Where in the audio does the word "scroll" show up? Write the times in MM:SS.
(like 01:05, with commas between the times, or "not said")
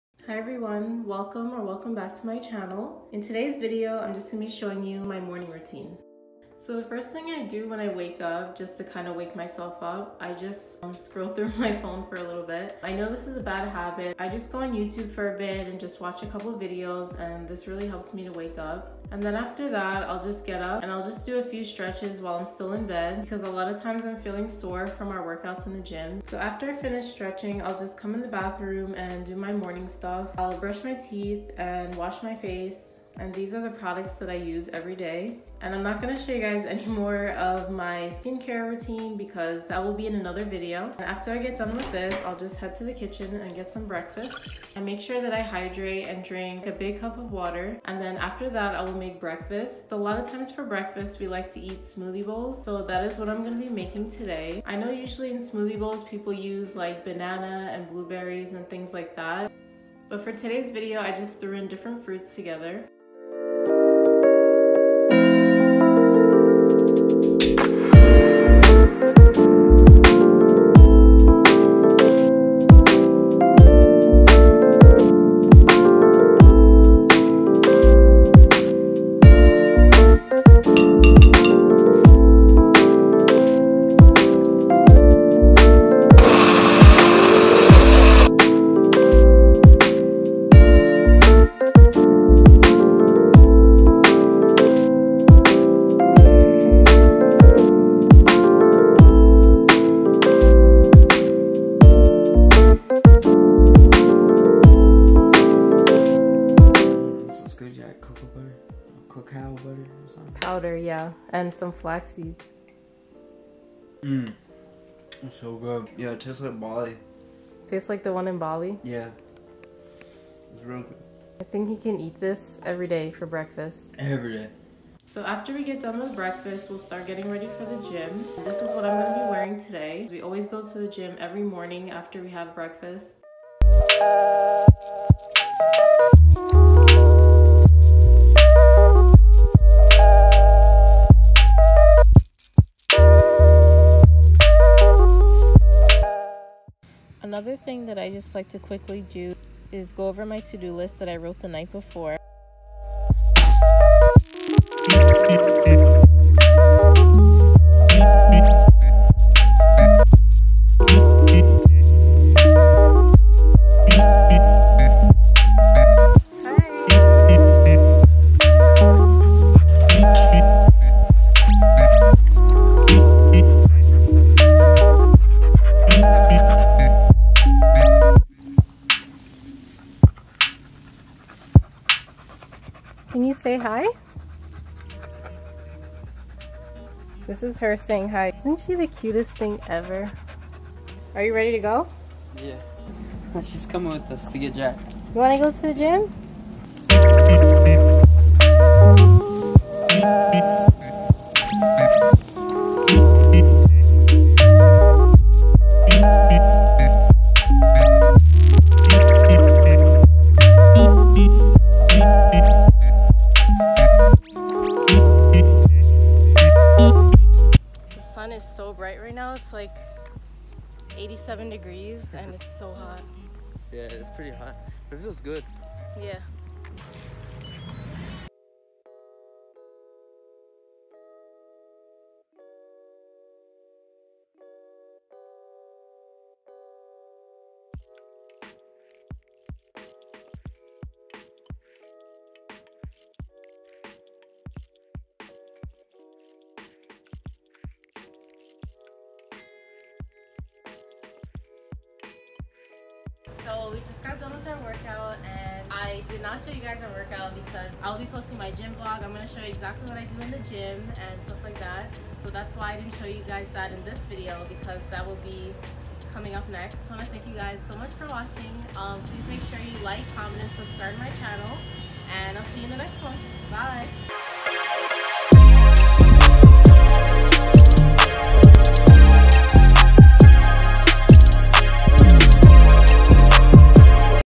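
00:10.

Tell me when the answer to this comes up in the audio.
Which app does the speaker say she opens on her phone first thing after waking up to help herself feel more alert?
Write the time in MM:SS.
00:14.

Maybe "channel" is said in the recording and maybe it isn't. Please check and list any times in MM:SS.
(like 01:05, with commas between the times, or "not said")
00:02, 04:31.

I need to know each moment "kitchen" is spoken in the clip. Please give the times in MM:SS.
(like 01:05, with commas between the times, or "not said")
00:42.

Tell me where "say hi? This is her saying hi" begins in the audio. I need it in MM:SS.
03:03.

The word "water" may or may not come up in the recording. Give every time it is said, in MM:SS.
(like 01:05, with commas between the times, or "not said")
00:47.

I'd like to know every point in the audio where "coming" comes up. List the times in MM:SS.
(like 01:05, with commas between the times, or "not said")
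03:13, 04:26.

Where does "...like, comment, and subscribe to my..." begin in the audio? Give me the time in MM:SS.
04:29.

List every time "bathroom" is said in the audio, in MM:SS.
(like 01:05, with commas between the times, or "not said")
00:28.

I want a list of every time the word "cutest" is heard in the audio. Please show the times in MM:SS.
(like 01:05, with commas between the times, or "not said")
03:08.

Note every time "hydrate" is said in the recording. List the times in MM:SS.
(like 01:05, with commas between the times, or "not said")
00:45.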